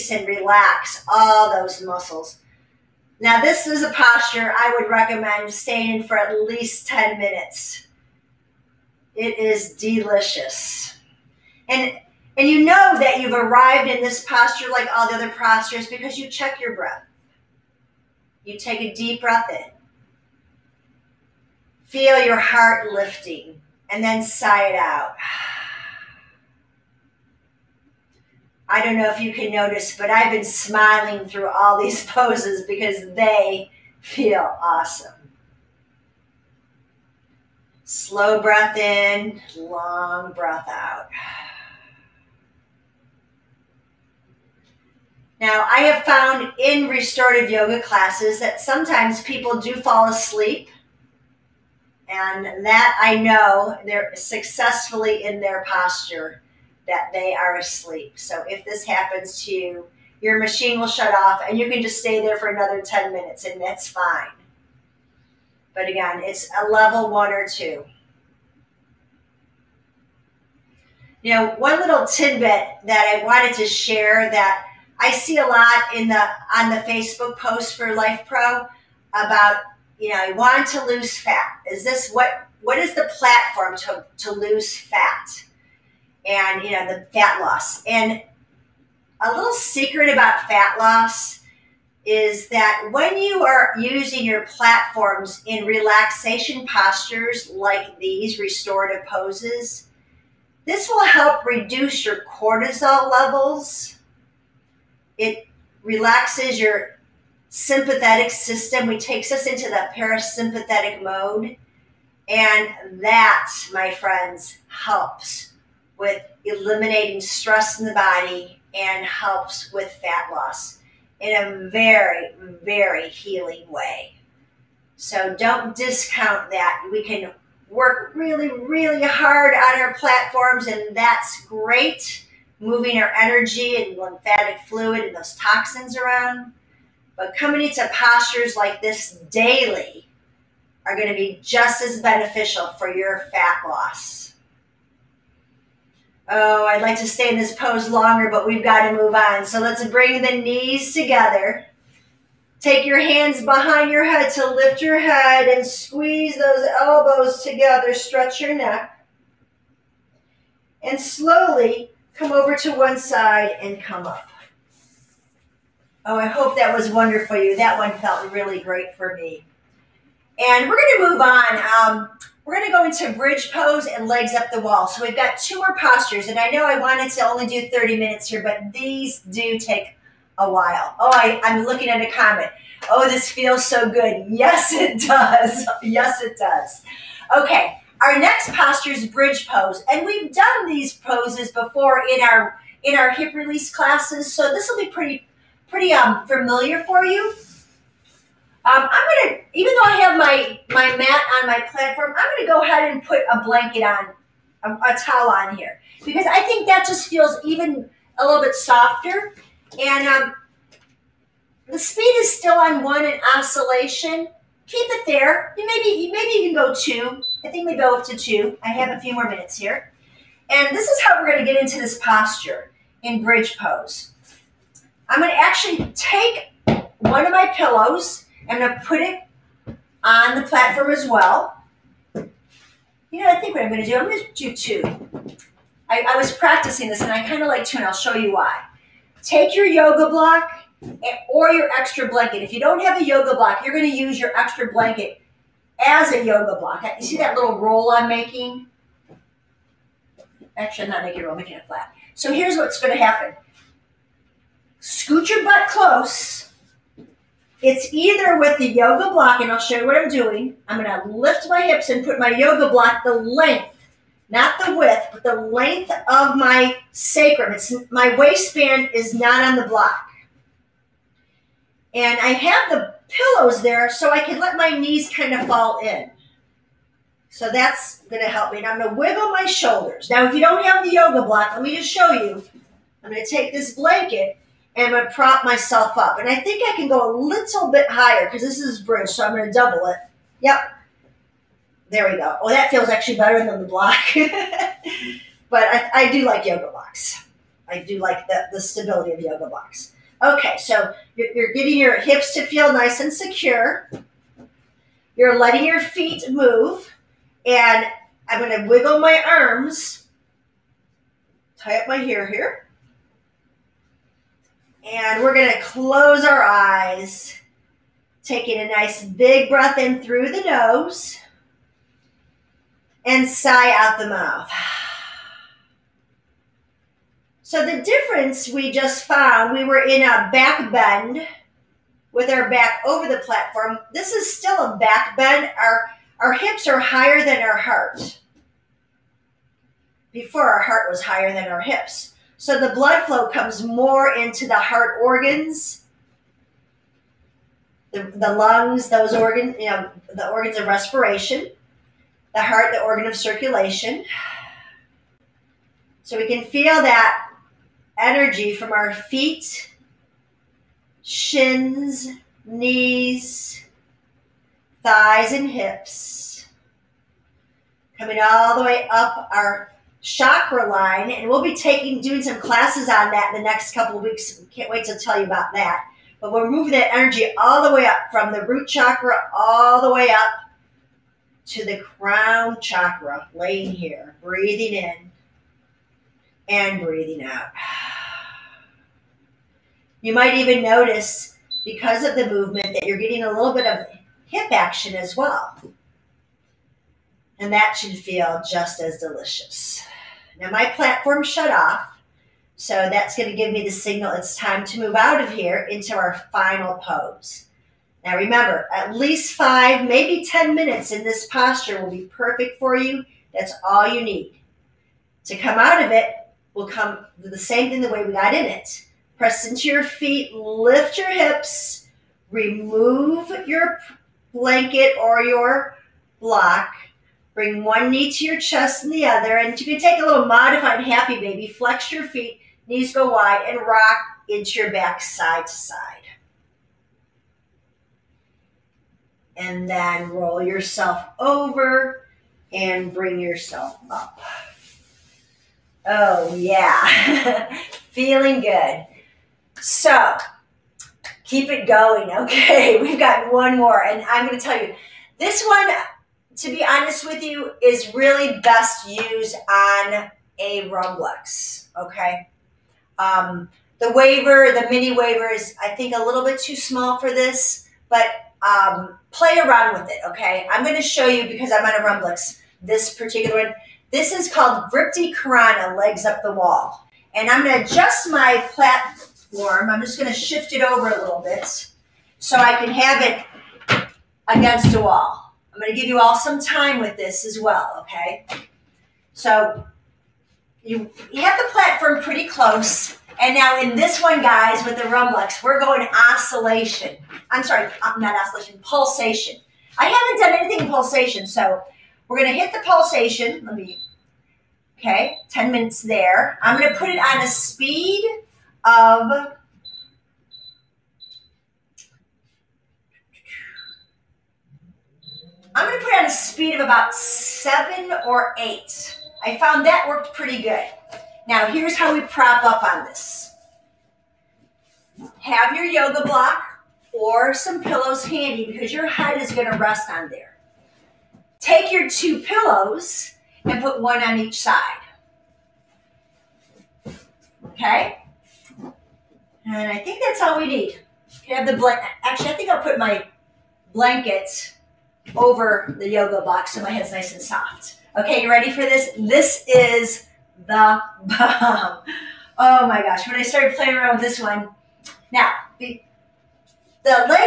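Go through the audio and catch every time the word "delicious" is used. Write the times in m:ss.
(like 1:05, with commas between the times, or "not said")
0:09, 6:38.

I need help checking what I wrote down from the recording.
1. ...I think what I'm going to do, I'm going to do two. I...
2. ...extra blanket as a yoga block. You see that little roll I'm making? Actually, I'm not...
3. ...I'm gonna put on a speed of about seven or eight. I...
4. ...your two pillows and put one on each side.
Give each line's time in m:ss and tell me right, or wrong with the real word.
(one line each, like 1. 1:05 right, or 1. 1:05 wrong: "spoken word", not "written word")
1. 3:53 right
2. 4:04 right
3. 8:35 right
4. 8:51 right.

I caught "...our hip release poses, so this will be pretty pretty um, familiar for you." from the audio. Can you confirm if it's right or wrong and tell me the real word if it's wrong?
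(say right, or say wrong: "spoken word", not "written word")
wrong: "classes", not "poses".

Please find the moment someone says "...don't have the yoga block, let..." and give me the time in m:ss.
4:40.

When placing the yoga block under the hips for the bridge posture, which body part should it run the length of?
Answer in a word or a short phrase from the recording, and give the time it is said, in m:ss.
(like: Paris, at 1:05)
Sacrum, at 4:26.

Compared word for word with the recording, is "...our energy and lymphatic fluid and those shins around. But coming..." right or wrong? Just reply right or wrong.
wrong.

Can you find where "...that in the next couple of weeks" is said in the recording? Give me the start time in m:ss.
6:13.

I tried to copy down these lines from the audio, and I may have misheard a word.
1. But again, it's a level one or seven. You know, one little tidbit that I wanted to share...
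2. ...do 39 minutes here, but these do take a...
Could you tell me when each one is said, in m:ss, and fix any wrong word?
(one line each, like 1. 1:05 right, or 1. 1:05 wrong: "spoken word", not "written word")
1. 1:05 wrong: "two", not "seven"
2. 2:57 wrong: "30", not "39".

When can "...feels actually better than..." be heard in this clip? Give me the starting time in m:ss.
4:52.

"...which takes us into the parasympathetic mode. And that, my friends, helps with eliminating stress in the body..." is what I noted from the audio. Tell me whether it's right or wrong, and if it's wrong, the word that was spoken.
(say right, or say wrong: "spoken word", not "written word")
right.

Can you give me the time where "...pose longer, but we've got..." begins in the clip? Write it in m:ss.
2:27.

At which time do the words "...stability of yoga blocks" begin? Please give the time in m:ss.
4:58.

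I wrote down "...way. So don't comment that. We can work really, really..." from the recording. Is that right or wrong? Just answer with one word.
wrong.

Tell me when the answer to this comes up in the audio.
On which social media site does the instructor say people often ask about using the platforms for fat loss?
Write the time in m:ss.
1:16.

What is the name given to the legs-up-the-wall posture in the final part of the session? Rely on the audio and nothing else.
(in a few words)
Vripti Karana.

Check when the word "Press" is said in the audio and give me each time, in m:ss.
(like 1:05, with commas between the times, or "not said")
6:59.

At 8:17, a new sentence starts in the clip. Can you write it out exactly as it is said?
I'm sorry, uh, not oscillation, pulsation.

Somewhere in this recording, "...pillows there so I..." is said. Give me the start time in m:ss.
4:33.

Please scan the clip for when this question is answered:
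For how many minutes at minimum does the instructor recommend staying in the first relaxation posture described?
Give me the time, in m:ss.
0:06.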